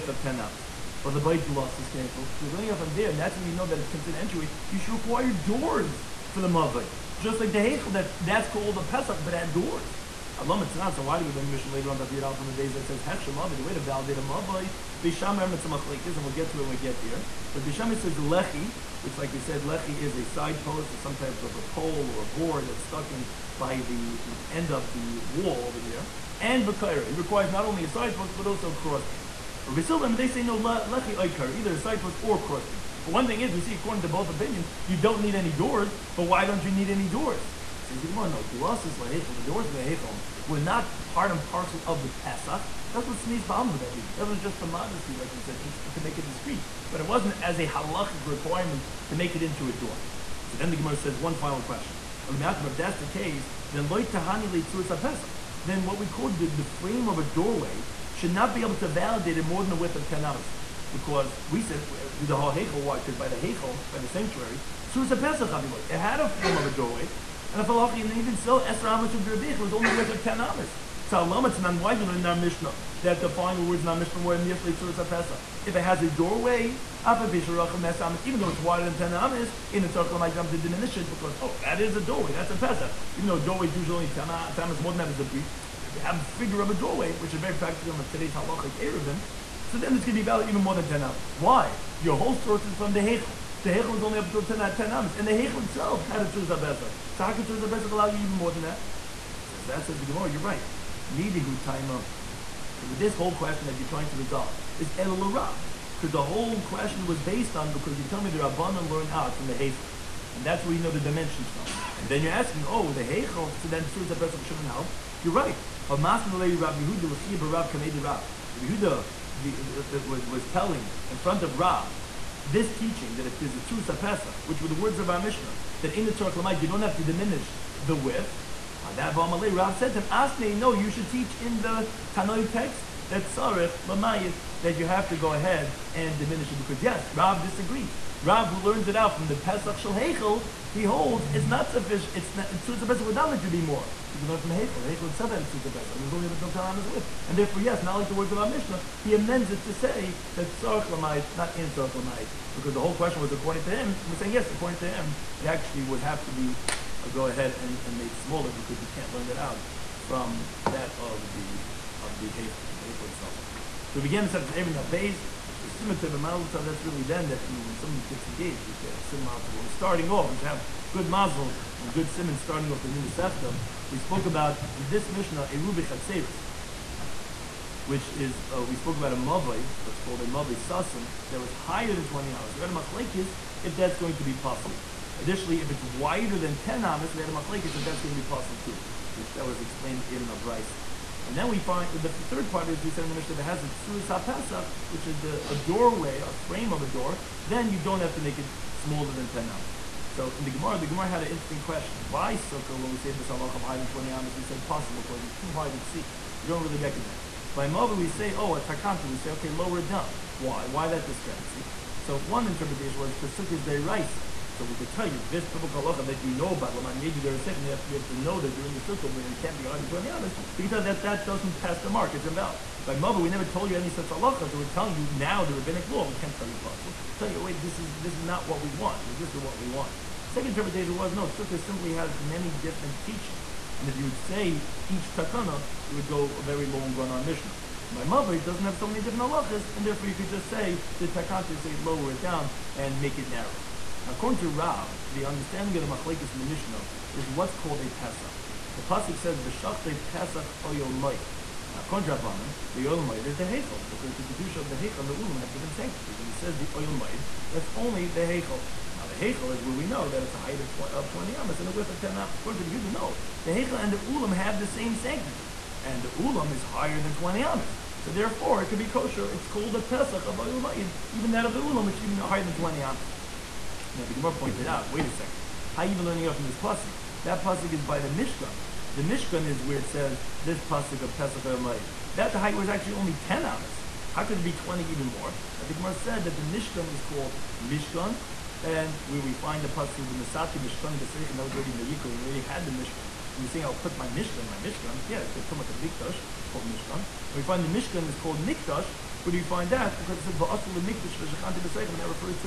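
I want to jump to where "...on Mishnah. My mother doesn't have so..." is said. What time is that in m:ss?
3:57.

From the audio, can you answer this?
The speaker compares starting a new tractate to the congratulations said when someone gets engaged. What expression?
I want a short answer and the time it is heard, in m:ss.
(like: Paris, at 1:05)
mazel tov, at 2:46.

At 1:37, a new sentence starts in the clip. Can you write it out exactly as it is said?
So how could Tzarech Pesach allow you even more than that?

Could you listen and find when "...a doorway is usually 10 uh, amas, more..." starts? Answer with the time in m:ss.
1:23.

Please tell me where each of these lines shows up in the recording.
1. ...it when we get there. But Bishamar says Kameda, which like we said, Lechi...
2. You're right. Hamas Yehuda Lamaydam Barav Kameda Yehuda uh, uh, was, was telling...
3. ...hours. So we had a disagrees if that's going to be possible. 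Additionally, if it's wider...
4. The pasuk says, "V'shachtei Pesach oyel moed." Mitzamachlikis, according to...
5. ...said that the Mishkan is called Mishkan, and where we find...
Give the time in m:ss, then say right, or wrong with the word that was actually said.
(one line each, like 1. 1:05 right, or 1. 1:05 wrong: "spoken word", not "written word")
1. 0:16 wrong: "Lechi", not "Kameda"
2. 1:55 wrong: "Lechia", not "Lamaydam"
3. 3:02 wrong: "machlekes", not "disagrees"
4. 4:08 wrong: "Now", not "Mitzamachlikis"
5. 4:45 right.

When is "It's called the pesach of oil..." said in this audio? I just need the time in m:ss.
4:29.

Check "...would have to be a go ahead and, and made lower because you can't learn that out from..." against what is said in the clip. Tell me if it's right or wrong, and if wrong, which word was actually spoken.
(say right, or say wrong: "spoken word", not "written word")
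wrong: "smaller", not "lower".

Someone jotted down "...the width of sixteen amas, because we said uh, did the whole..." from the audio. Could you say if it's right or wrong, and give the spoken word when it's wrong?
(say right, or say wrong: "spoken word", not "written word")
wrong: "ten", not "sixteen".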